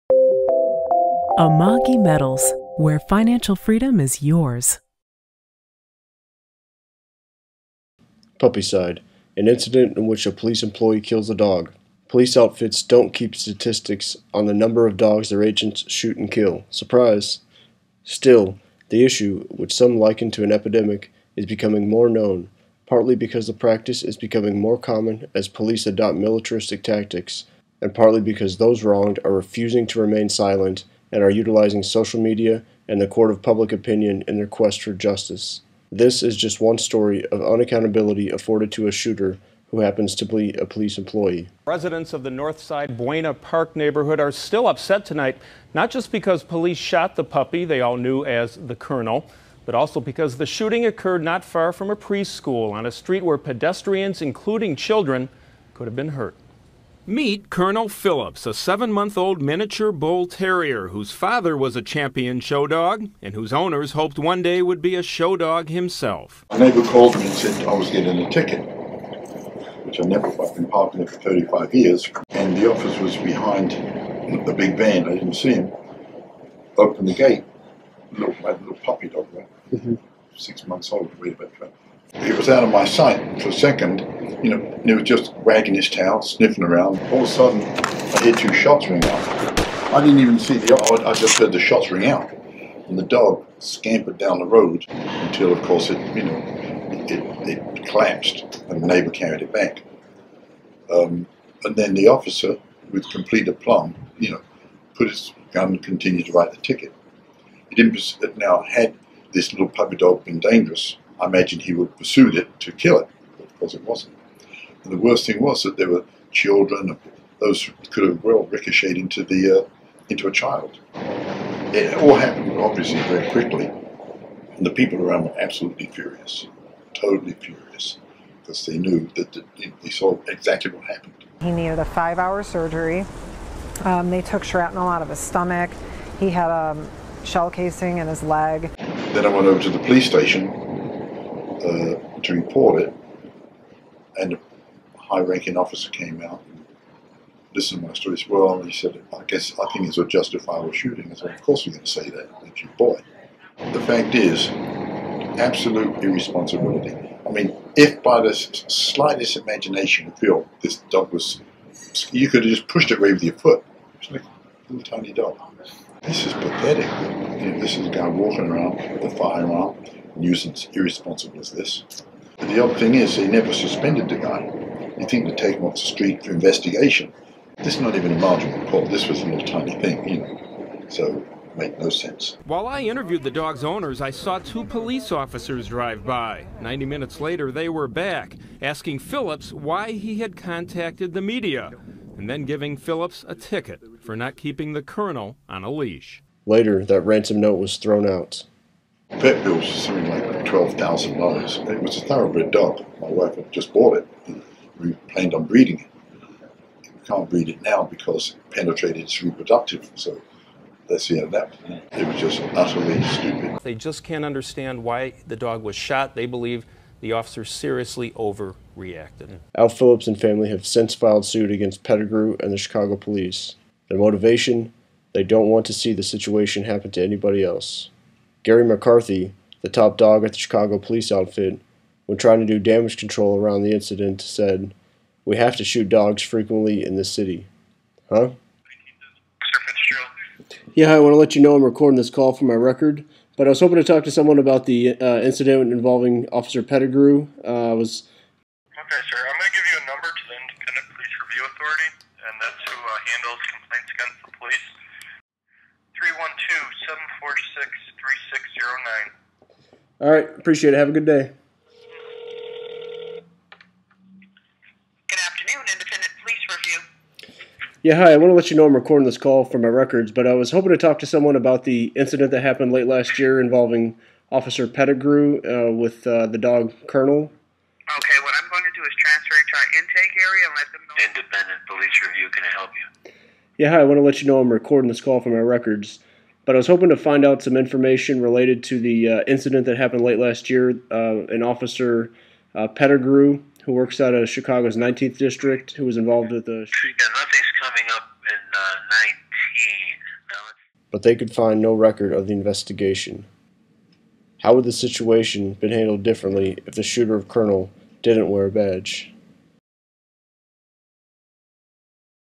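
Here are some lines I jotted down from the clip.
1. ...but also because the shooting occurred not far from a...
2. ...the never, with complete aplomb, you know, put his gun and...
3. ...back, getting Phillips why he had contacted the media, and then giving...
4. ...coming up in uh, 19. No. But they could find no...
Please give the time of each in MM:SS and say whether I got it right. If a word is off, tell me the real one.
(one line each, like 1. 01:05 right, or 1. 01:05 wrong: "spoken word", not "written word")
1. 00:49 right
2. 01:41 wrong: "officer", not "never"
3. 03:07 wrong: "asking", not "getting"
4. 04:57 right.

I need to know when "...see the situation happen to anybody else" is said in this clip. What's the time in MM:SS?
03:45.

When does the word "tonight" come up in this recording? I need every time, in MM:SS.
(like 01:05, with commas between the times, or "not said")
00:45.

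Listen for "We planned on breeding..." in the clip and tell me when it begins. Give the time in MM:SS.
03:24.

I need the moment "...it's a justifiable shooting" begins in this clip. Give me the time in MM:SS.
02:29.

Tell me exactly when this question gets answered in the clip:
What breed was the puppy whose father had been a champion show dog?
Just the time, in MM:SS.
00:59.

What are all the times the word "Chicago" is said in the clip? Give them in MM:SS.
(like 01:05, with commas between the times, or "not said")
03:42, 03:50, 04:54.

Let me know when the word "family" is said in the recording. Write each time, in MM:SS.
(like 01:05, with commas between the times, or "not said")
03:40.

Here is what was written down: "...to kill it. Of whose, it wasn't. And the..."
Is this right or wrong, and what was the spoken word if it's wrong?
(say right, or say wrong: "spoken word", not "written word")
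wrong: "course", not "whose".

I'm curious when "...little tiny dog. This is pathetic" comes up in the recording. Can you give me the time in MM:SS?
02:44.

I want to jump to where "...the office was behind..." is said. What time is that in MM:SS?
01:12.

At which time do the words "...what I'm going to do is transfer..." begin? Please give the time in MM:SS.
04:38.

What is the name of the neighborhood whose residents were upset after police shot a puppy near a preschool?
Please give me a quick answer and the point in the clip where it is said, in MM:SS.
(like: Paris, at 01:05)
Northside Buena Park, at 00:42.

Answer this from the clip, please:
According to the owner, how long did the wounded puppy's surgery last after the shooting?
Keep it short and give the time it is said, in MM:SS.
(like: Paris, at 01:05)
5 hours, at 02:11.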